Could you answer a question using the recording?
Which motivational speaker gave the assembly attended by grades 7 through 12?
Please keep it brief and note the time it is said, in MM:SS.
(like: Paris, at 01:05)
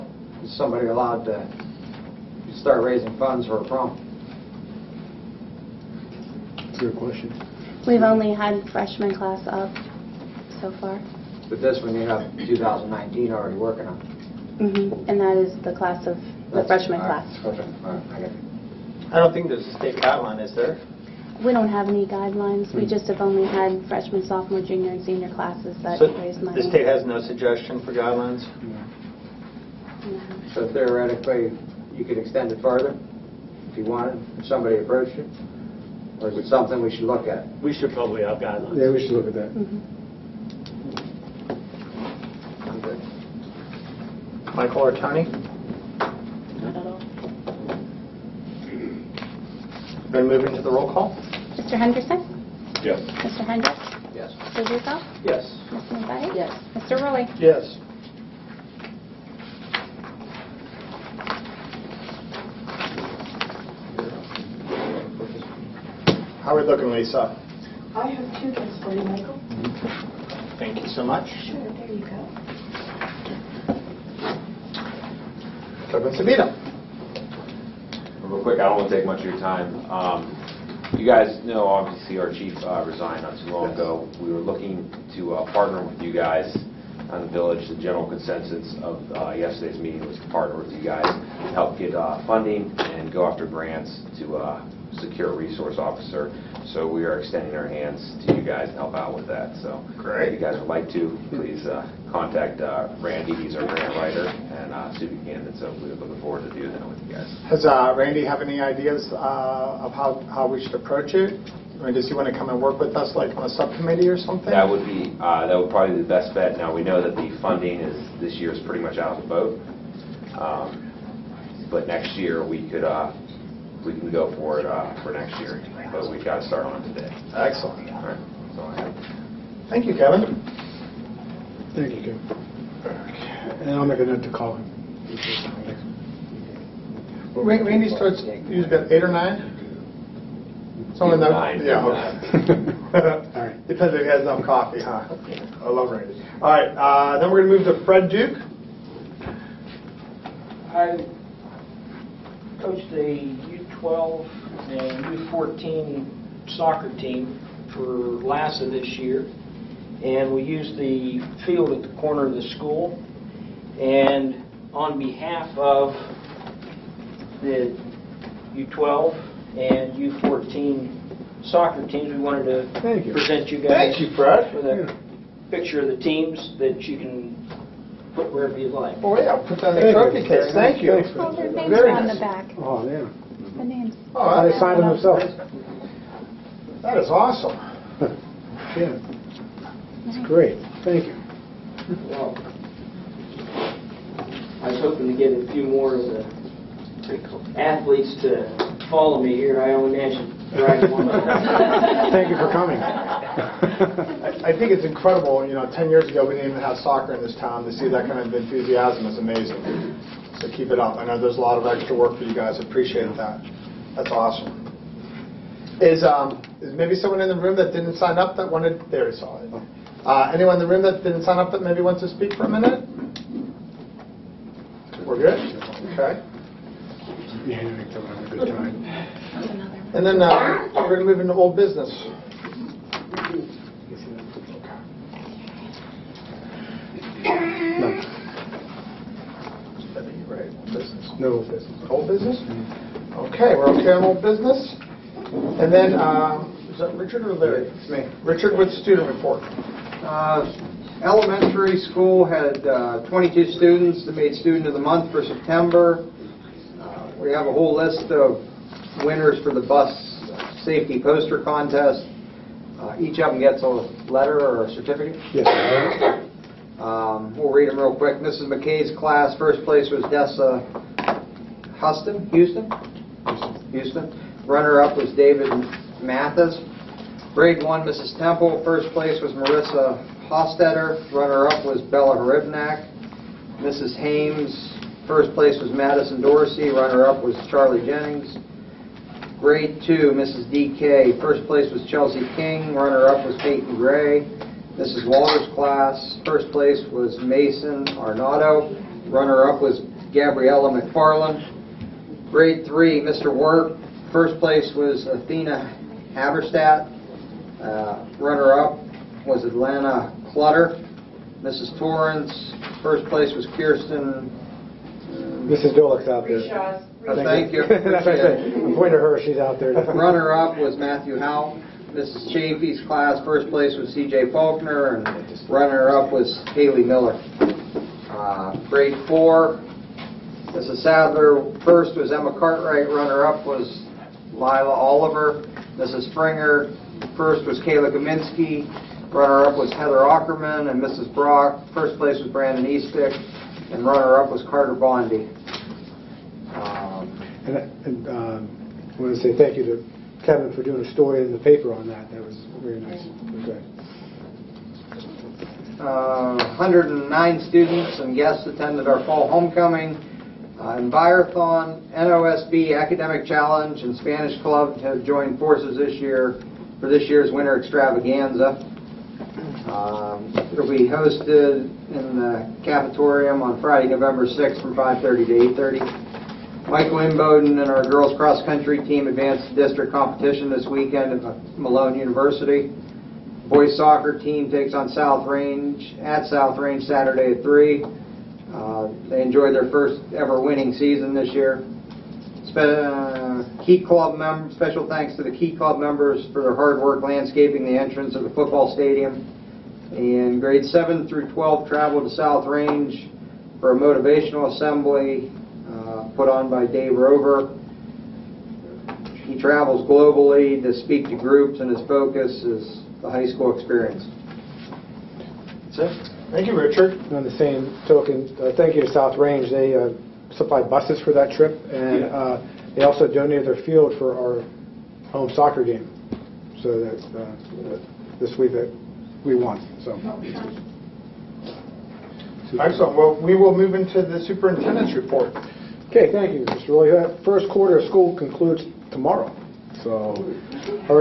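Dave Roever, at 06:46.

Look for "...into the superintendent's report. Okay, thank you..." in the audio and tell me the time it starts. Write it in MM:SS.
07:13.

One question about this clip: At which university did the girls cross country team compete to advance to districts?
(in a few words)
Malone University.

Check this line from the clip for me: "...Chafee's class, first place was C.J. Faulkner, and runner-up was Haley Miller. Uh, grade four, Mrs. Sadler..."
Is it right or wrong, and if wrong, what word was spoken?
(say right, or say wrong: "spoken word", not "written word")
right.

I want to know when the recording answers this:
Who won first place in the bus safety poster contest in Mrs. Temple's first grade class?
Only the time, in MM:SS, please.
04:39.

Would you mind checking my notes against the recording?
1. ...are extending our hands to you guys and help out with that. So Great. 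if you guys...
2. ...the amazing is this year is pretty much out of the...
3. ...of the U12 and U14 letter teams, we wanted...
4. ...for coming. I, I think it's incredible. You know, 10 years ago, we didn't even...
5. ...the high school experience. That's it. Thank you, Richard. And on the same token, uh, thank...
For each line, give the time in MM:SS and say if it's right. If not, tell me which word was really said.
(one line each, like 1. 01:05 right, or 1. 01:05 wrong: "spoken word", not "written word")
1. 01:37 right
2. 01:57 wrong: "funding", not "amazing"
3. 02:45 wrong: "soccer", not "letter"
4. 03:22 right
5. 06:53 right.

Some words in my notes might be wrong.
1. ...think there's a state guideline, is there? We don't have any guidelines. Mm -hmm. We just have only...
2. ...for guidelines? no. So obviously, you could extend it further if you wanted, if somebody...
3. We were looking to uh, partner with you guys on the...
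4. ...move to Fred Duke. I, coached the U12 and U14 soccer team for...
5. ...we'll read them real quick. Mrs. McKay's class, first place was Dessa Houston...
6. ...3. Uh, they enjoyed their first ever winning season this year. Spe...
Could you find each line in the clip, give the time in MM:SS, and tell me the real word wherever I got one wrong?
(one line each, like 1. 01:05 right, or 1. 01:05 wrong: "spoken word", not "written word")
1. 00:19 right
2. 00:27 wrong: "theoretically", not "obviously"
3. 01:24 right
4. 02:27 right
5. 04:27 right
6. 06:27 right.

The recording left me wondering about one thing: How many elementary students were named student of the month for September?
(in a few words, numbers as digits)
22.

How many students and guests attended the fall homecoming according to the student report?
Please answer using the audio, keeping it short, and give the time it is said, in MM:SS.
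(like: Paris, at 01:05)
109, at 05:56.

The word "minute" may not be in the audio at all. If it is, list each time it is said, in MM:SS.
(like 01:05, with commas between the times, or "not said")
03:42.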